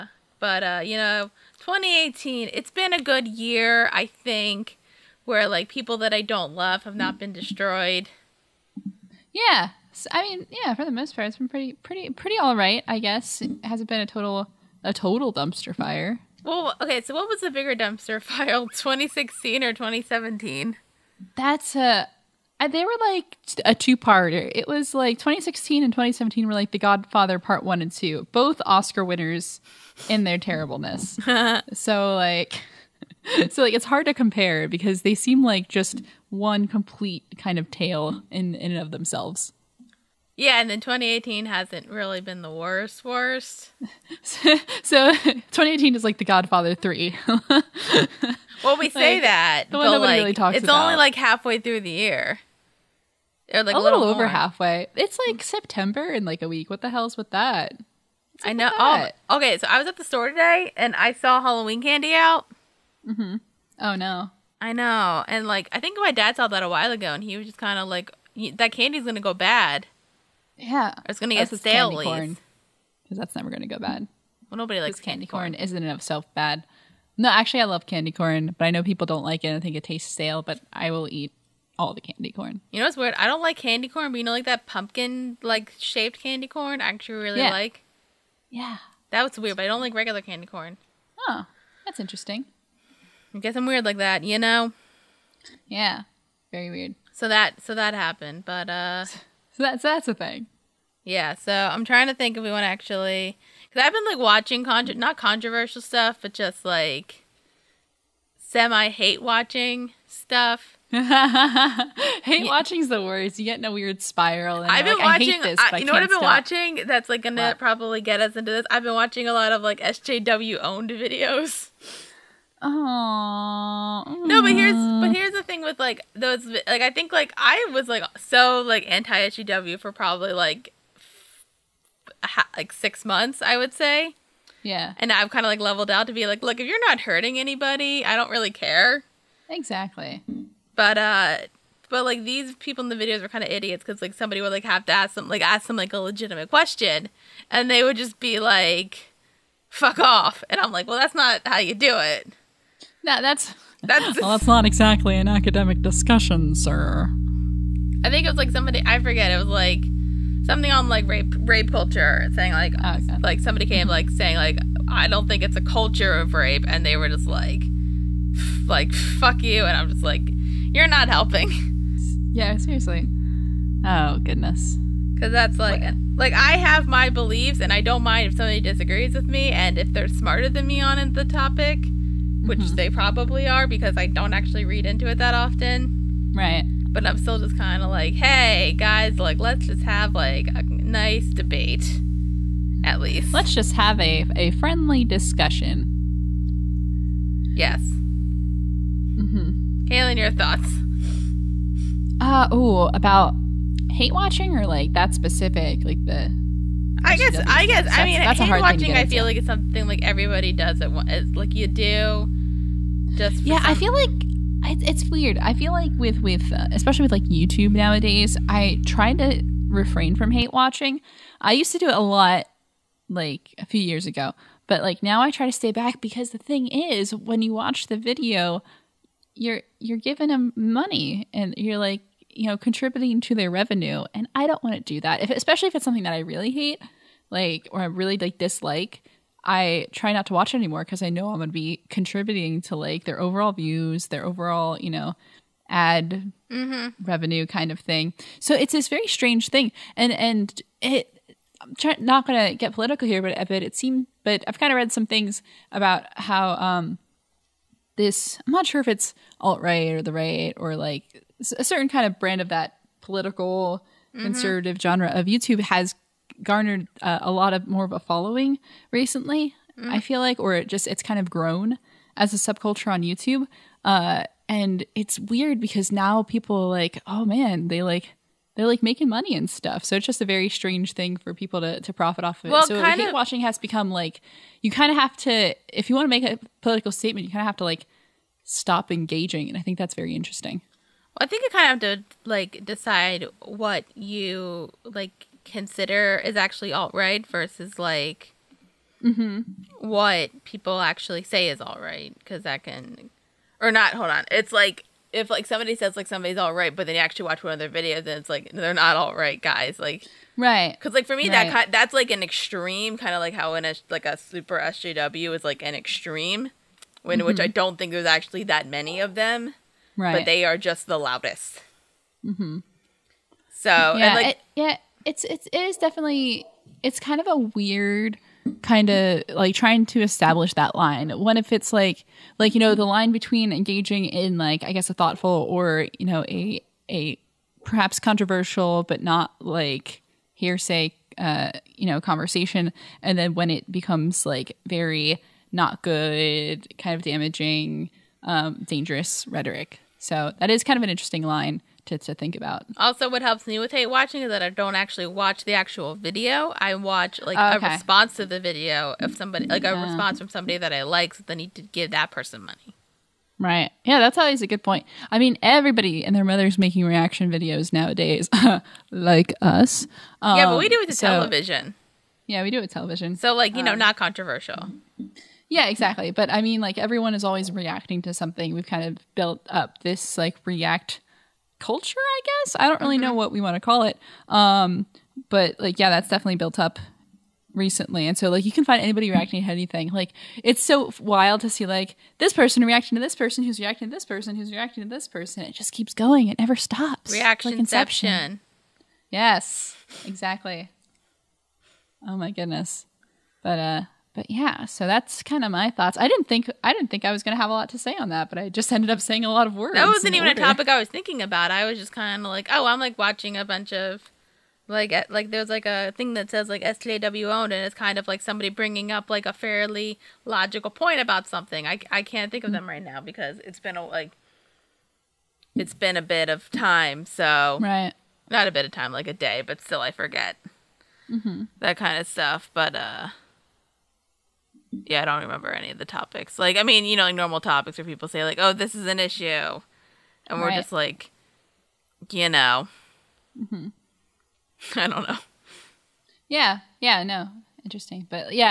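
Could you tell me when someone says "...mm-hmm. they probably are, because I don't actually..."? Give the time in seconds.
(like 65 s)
182 s.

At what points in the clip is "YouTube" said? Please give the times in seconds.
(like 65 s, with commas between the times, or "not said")
217 s, 265 s, 273 s.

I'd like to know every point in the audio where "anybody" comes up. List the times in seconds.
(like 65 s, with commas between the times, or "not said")
137 s, 388 s.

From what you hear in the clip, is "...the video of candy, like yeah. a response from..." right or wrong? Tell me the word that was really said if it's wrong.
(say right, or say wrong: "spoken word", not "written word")
wrong: "somebody", not "candy".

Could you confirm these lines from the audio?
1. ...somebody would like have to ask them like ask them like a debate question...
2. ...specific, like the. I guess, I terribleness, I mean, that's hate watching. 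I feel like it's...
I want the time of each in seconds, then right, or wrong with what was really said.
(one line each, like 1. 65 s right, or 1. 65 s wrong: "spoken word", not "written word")
1. 144 s wrong: "legitimate", not "debate"
2. 205 s wrong: "guess", not "terribleness".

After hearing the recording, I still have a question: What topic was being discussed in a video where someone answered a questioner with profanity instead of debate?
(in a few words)
Rape culture.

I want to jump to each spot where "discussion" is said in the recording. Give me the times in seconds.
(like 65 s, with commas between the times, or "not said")
155 s, 195 s.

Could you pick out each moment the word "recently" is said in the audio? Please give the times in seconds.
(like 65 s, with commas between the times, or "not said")
268 s, 387 s.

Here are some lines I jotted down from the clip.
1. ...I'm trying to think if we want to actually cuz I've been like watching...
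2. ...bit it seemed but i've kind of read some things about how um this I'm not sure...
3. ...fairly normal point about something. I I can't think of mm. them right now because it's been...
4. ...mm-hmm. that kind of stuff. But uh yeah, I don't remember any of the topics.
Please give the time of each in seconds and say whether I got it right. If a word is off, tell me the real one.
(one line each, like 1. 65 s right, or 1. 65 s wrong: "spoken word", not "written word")
1. 101 s right
2. 253 s right
3. 419 s wrong: "logical", not "normal"
4. 431 s right.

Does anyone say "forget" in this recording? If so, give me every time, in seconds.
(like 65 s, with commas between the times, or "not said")
158 s, 429 s.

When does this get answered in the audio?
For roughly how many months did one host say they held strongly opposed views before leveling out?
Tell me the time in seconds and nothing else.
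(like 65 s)
132 s.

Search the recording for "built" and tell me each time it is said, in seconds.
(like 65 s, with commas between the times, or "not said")
379 s, 386 s.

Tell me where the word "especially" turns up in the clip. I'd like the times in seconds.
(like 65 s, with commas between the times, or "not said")
216 s, 235 s.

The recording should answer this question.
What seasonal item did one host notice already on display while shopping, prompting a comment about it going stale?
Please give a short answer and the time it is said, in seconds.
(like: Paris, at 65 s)
Halloween candy, at 61 s.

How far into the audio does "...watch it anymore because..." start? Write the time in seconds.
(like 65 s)
240 s.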